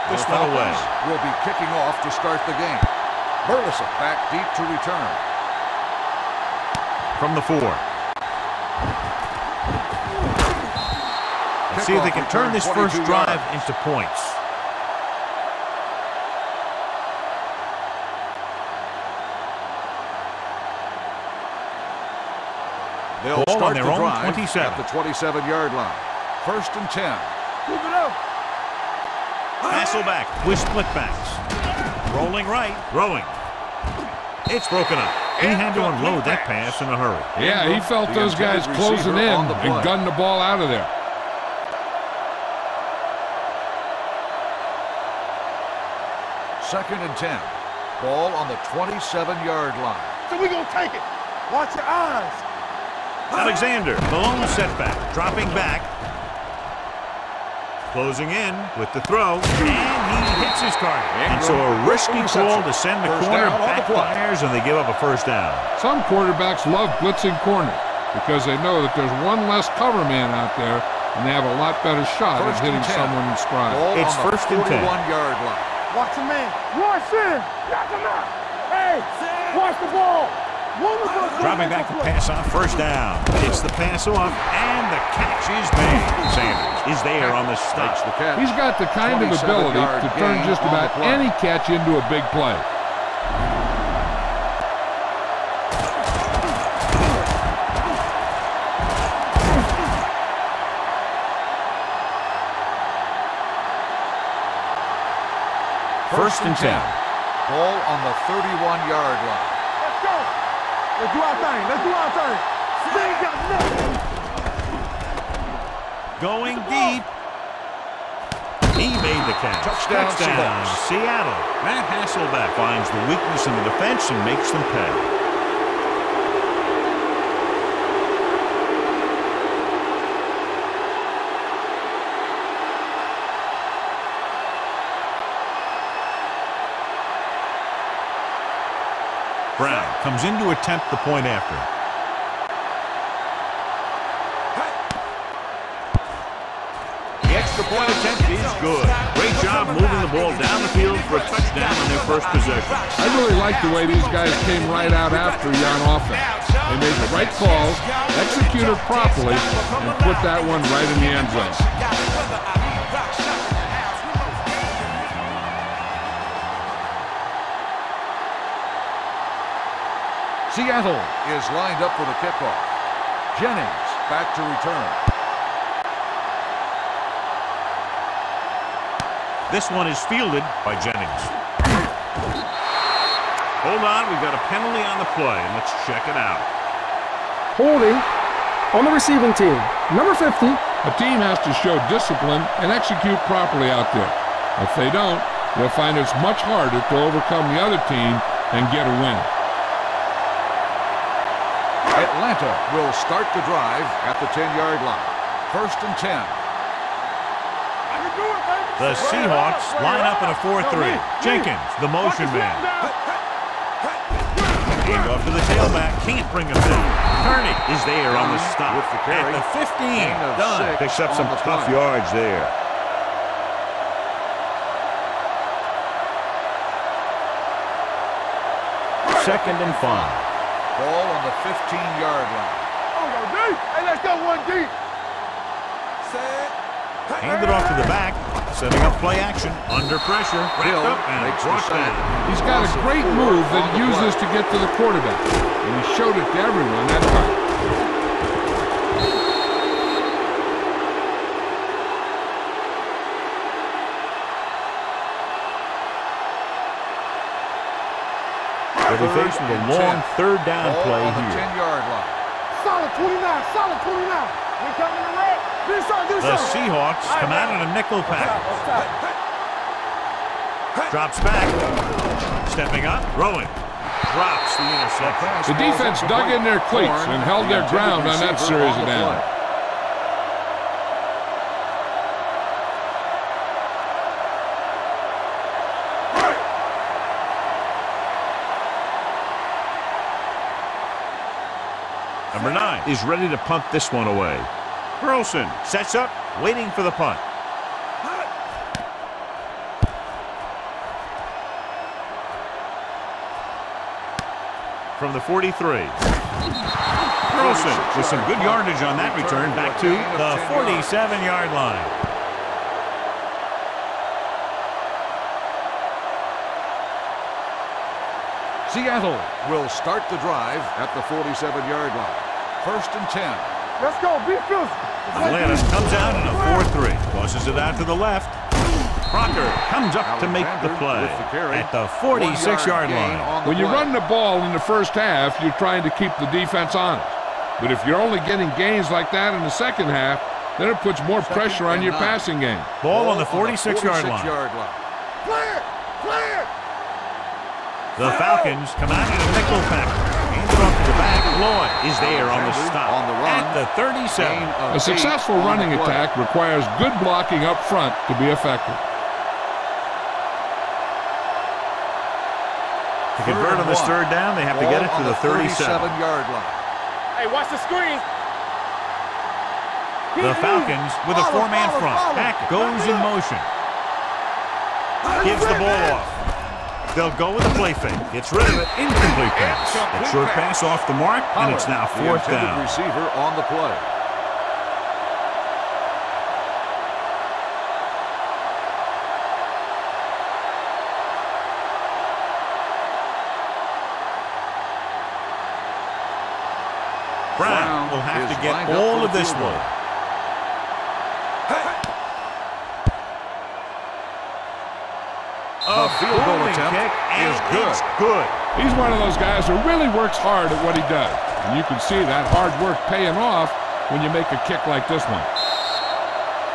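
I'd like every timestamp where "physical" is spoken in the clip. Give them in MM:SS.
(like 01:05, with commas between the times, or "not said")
05:24.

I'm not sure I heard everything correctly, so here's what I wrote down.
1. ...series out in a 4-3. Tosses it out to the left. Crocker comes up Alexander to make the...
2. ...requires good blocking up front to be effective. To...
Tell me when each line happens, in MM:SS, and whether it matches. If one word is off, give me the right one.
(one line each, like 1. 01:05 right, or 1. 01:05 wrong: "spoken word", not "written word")
1. 05:25 wrong: "comes", not "series"
2. 05:56 right.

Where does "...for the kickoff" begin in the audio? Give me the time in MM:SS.
02:51.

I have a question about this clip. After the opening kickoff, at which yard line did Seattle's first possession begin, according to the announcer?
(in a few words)
27.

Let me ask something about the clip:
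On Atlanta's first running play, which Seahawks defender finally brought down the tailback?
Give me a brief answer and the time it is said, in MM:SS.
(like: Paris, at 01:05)
Kerney, at 03:37.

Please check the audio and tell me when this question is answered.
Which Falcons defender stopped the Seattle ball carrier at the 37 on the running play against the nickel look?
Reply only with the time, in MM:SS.
05:51.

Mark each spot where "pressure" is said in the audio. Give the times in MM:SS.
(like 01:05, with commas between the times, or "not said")
04:00, 05:41.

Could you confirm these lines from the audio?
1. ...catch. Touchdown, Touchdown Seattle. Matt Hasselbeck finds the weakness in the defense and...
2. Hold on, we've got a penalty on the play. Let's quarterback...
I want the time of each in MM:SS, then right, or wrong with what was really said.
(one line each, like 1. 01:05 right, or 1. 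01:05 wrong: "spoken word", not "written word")
1. 01:59 right
2. 03:03 wrong: "check", not "quarterback".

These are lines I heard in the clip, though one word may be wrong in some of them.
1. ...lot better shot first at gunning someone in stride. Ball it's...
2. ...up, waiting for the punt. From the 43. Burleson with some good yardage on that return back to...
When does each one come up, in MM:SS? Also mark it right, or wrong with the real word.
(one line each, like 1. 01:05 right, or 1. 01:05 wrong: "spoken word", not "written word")
1. 01:11 wrong: "hitting", not "gunning"
2. 04:55 right.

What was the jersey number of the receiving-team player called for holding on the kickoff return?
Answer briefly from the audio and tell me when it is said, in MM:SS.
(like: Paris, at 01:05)
50, at 03:09.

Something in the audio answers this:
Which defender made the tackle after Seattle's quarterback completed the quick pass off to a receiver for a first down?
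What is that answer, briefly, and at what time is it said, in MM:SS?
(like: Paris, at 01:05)
Sanders, at 01:26.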